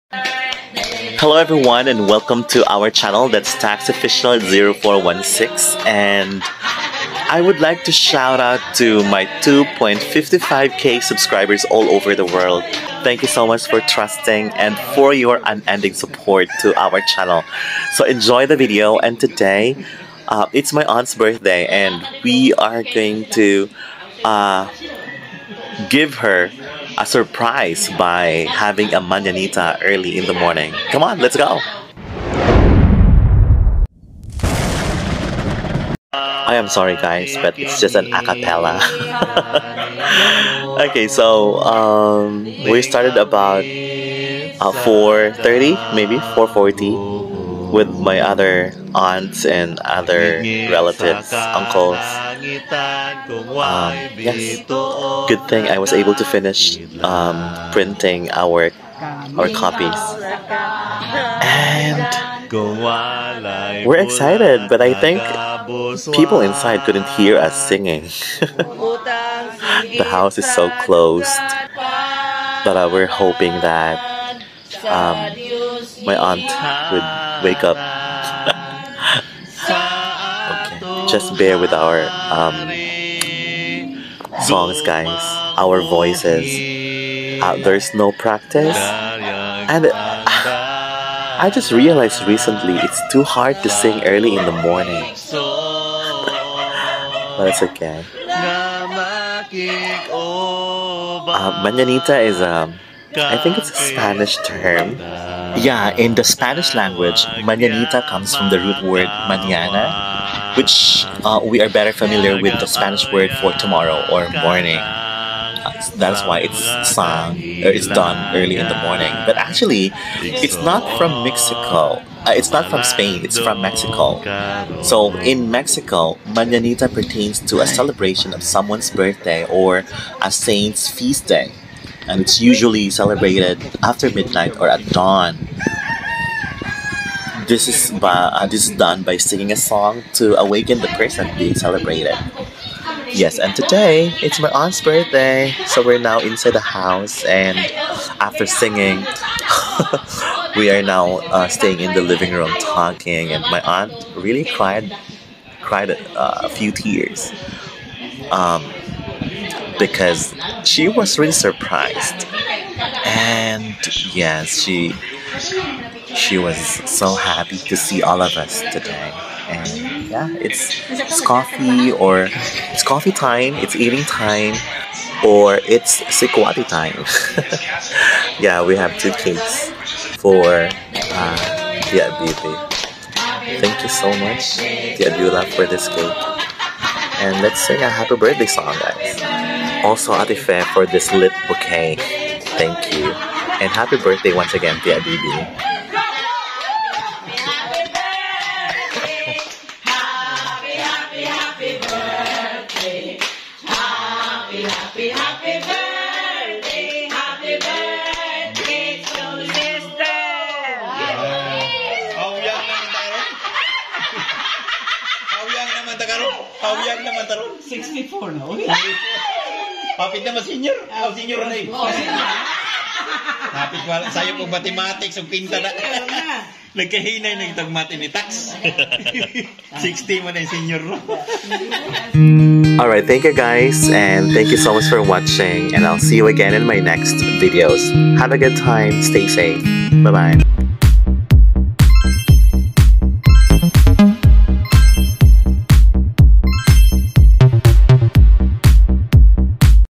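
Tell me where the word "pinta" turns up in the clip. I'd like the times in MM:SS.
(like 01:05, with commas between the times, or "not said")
03:45.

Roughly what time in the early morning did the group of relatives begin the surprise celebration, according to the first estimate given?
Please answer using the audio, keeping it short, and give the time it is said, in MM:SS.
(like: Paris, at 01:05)
4:30, at 00:44.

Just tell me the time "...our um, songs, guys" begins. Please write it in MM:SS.
01:21.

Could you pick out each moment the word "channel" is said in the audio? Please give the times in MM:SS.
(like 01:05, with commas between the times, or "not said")
00:02, 00:17.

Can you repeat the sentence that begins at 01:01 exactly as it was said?
And we're excited, but I think people inside couldn't hear us singing.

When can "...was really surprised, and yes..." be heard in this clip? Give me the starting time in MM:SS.
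02:40.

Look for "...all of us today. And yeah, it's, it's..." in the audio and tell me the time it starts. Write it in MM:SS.
02:48.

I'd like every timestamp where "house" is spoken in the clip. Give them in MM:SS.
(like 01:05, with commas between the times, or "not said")
01:10, 02:26.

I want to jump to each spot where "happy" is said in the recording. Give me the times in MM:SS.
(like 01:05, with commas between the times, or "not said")
02:47, 03:07.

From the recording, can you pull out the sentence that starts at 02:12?
And it's usually celebrated after midnight or at dawn.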